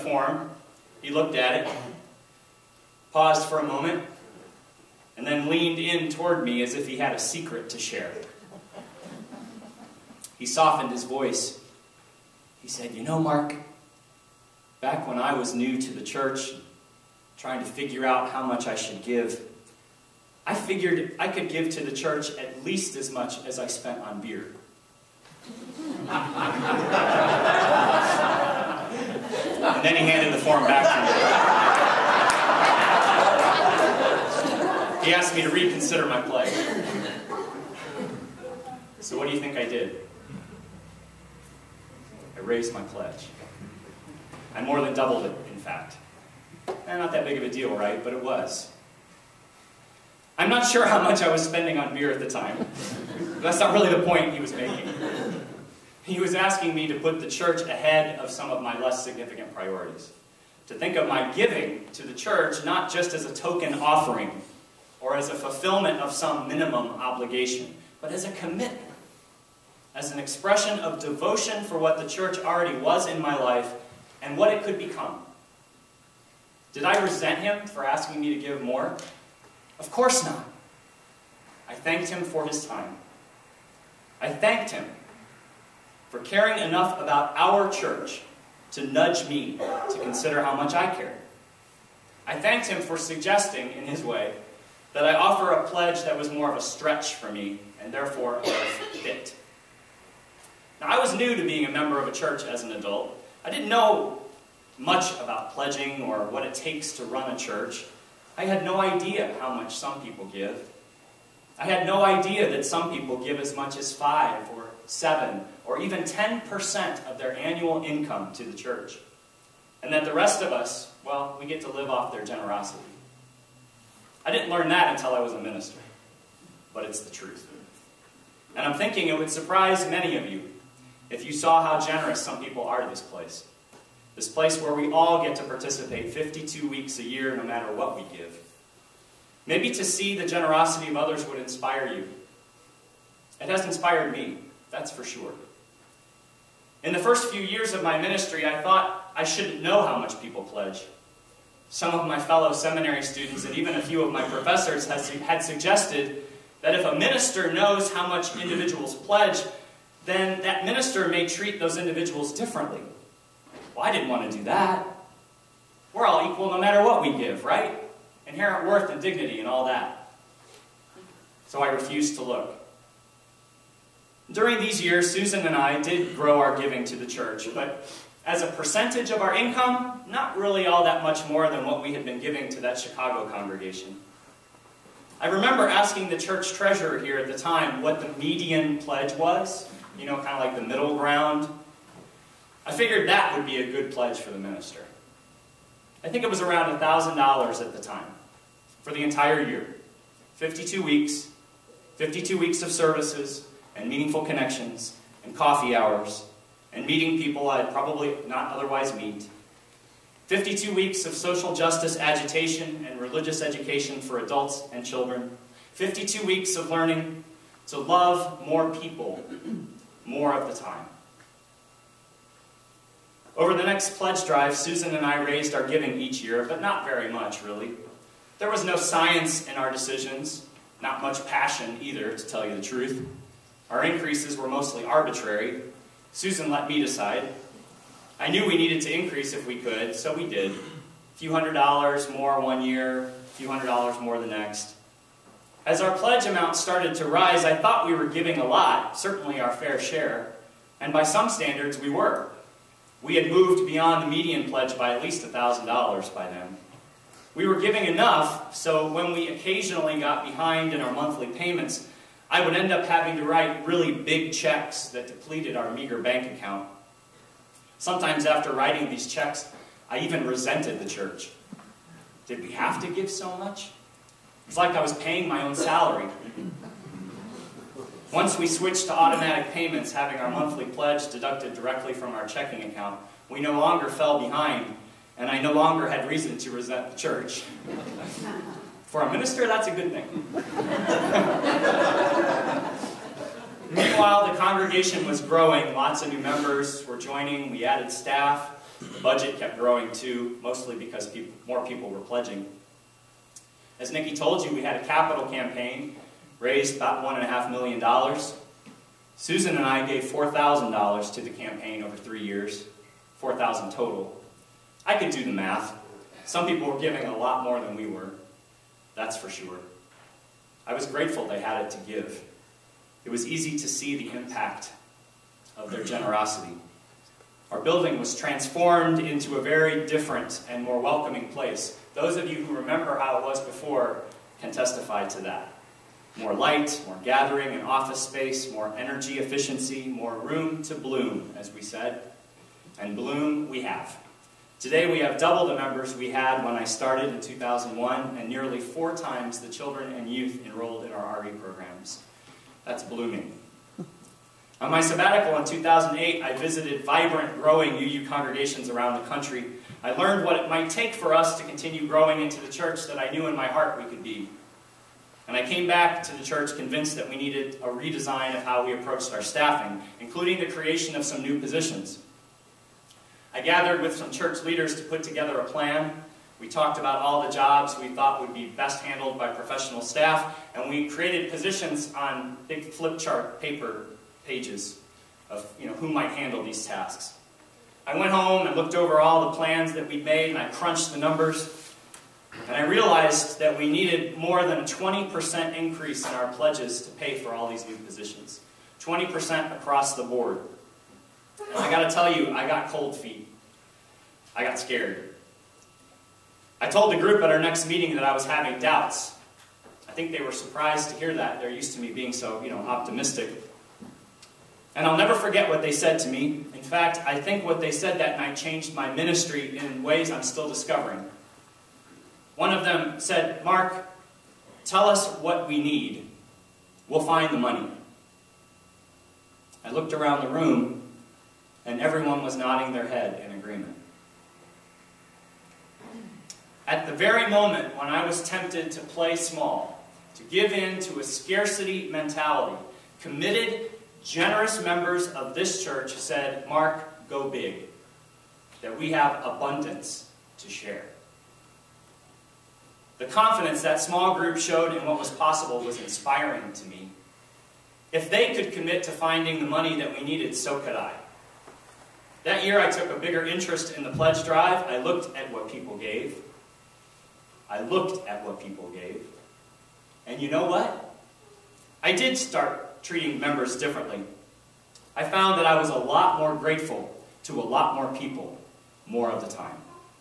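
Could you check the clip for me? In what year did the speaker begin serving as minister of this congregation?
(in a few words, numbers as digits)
2001.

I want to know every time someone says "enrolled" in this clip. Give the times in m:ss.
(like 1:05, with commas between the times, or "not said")
5:50.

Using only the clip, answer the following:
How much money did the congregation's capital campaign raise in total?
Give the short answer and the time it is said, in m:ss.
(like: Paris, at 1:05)
$1.5 million, at 5:07.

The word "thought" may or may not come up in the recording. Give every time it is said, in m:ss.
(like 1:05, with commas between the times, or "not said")
2:28, 4:07, 6:17.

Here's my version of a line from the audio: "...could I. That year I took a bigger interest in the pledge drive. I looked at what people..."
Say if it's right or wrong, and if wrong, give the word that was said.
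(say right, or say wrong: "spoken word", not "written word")
right.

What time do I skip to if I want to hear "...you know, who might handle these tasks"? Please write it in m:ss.
6:25.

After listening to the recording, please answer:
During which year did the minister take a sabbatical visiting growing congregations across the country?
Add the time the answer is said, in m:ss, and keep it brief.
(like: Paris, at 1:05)
2008, at 5:55.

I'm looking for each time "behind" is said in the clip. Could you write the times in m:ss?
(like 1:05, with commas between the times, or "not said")
4:20, 4:44.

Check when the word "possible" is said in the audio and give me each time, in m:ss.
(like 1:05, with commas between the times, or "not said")
7:35.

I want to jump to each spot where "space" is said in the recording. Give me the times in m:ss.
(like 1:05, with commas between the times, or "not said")
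5:38.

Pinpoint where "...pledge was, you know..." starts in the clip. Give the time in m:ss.
3:08.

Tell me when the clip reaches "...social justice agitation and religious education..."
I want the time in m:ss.
3:31.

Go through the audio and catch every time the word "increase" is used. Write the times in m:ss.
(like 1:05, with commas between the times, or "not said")
3:53, 3:58, 6:35.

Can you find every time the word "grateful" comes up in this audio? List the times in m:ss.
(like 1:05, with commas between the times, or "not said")
5:20, 7:56.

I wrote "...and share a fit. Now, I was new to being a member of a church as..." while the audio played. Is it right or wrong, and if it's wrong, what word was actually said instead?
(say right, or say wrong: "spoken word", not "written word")
wrong: "therefore", not "share".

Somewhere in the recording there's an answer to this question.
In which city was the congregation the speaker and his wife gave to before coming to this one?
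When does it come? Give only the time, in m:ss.
3:02.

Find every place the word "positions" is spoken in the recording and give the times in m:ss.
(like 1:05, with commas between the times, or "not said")
6:11, 6:21, 6:37.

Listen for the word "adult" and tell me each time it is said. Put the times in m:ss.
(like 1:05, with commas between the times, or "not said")
1:42, 3:34.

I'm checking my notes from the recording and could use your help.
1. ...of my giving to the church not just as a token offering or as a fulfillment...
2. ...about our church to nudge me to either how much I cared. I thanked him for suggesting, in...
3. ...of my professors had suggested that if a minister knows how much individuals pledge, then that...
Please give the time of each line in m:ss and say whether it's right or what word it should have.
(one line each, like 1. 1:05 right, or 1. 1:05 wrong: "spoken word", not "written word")
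1. 1:00 right
2. 1:27 wrong: "consider", not "either"
3. 2:34 right.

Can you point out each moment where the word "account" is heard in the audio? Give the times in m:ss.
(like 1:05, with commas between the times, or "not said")
4:26, 4:42.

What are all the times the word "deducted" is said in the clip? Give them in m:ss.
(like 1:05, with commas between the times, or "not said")
4:41.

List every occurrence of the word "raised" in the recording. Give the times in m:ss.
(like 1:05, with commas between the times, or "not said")
0:42, 3:45, 5:06.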